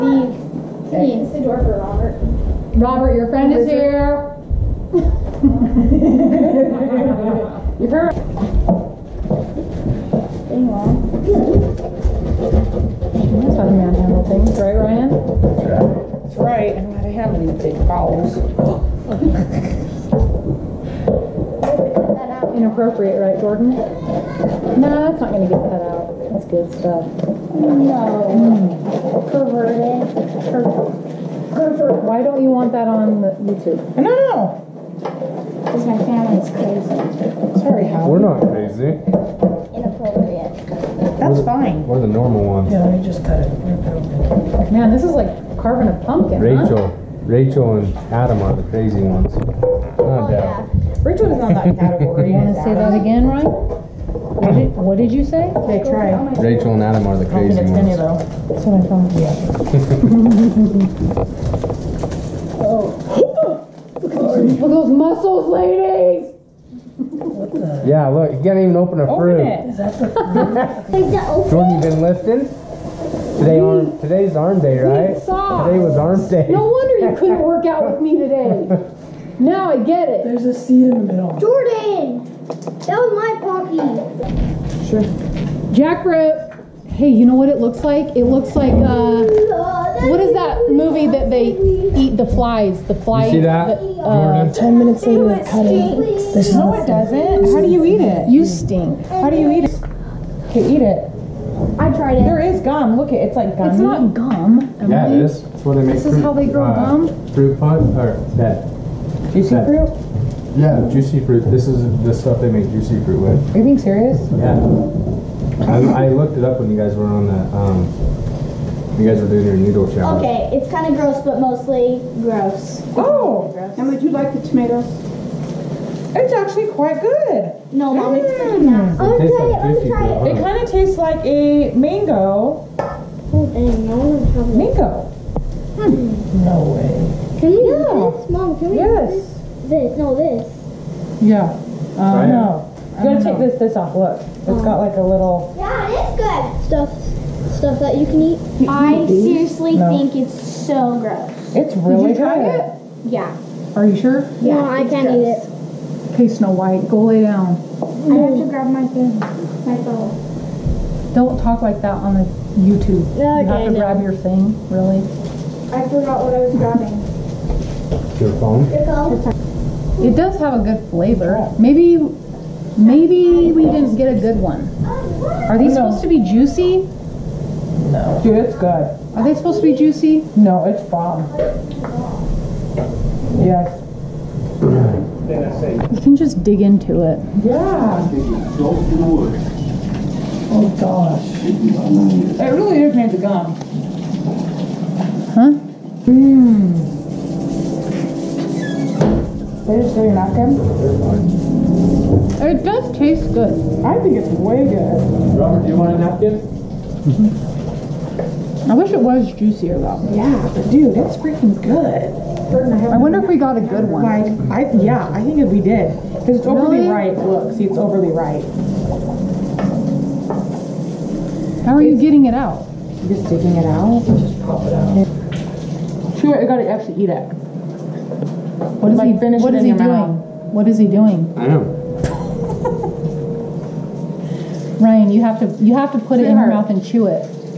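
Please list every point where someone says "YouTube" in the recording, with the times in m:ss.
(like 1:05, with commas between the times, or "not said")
0:33, 2:42.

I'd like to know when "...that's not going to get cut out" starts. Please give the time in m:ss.
0:24.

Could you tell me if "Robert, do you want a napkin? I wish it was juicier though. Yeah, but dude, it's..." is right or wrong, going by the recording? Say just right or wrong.
right.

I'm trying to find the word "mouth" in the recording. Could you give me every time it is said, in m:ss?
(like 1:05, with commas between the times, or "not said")
3:49, 3:56.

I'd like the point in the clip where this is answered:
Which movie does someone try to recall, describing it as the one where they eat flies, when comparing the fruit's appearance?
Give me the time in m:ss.
1:32.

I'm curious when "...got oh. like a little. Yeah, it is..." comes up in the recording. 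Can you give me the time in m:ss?
2:24.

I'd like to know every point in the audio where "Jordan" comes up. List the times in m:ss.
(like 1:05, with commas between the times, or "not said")
0:23, 1:11, 1:21.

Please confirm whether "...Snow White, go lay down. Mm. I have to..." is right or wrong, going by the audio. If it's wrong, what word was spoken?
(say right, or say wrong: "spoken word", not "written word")
right.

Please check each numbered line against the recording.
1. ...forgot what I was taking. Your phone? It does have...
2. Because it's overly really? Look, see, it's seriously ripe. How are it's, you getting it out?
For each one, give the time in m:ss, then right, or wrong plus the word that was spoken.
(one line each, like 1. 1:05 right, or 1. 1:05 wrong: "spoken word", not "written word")
1. 2:45 wrong: "grabbing", not "taking"
2. 3:36 wrong: "overly", not "seriously".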